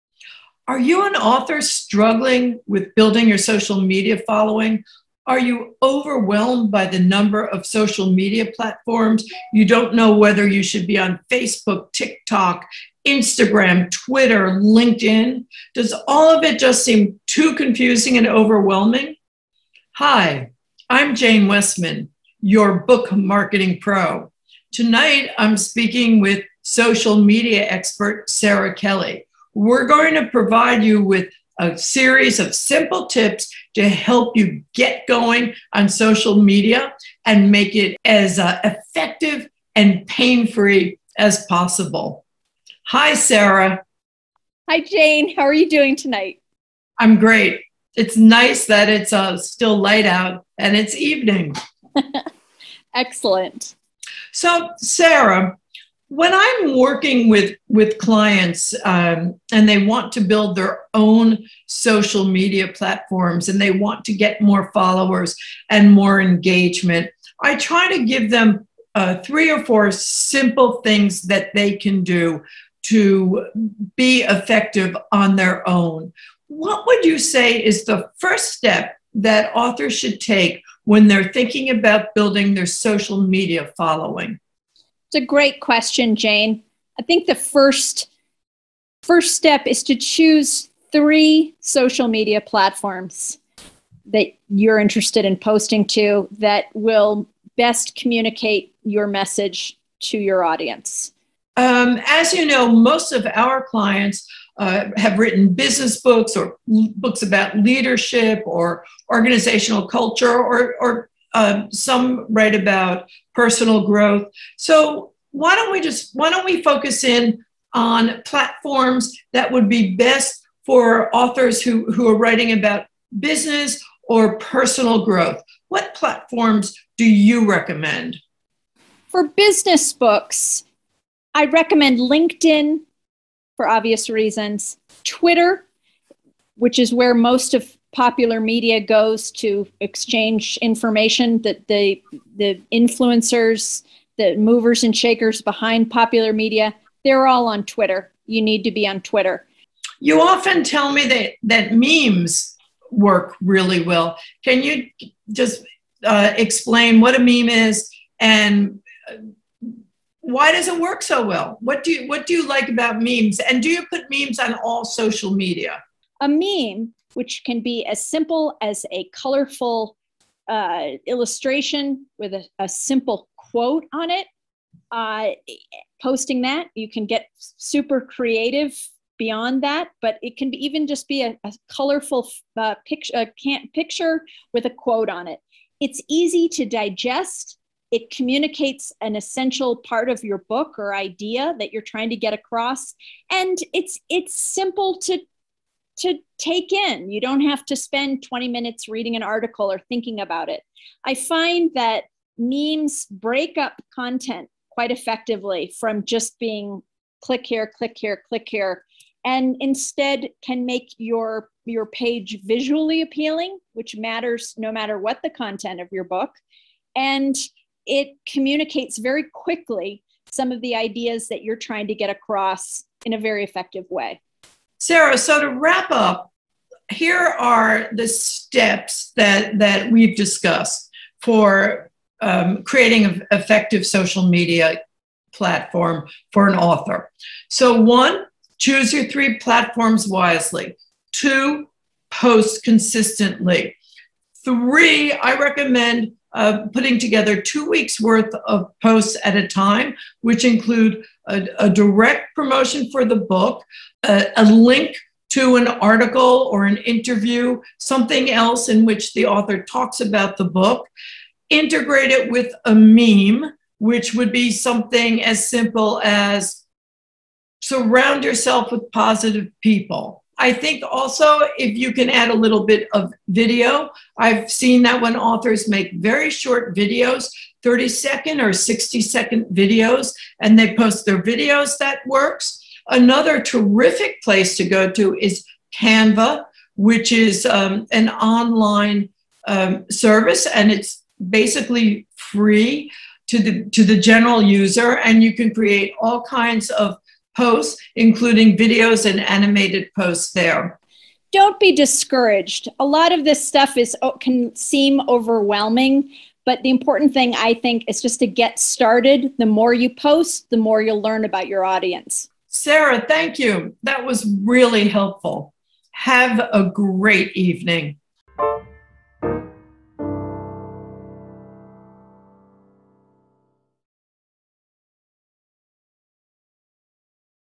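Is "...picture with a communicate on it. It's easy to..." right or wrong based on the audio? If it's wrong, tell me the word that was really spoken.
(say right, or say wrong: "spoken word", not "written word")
wrong: "quote", not "communicate".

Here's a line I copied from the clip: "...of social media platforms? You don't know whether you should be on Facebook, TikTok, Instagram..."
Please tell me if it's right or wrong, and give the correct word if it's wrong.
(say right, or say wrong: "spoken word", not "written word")
right.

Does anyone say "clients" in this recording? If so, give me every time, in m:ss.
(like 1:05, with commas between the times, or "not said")
0:57, 1:43.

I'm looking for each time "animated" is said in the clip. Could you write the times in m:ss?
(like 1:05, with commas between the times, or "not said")
4:59.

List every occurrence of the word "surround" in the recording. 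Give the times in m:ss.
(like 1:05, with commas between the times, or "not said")
4:27.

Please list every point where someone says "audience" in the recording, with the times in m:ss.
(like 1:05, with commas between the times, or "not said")
1:40, 5:11.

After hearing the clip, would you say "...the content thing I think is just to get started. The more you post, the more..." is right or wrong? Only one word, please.
wrong.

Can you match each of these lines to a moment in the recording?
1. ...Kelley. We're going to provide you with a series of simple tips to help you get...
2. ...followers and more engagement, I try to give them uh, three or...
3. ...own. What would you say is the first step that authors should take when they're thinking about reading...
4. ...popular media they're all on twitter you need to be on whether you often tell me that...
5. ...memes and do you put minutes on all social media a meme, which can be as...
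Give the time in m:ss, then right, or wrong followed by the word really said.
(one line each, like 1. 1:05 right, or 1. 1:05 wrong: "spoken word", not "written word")
1. 0:28 right
2. 1:04 right
3. 1:15 wrong: "building", not "reading"
4. 2:25 wrong: "twitter", not "whether"
5. 2:43 wrong: "memes", not "minutes".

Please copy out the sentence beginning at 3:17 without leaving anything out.
You don't have to spend 20 minutes reading an article or thinking about it.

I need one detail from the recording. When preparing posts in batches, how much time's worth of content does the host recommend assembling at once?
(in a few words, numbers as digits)
2 weeks.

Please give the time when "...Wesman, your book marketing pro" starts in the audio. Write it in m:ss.
0:21.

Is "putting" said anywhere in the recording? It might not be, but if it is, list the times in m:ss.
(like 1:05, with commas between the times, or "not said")
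4:06.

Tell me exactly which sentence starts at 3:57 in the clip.
So, one, choose your three platforms wisely.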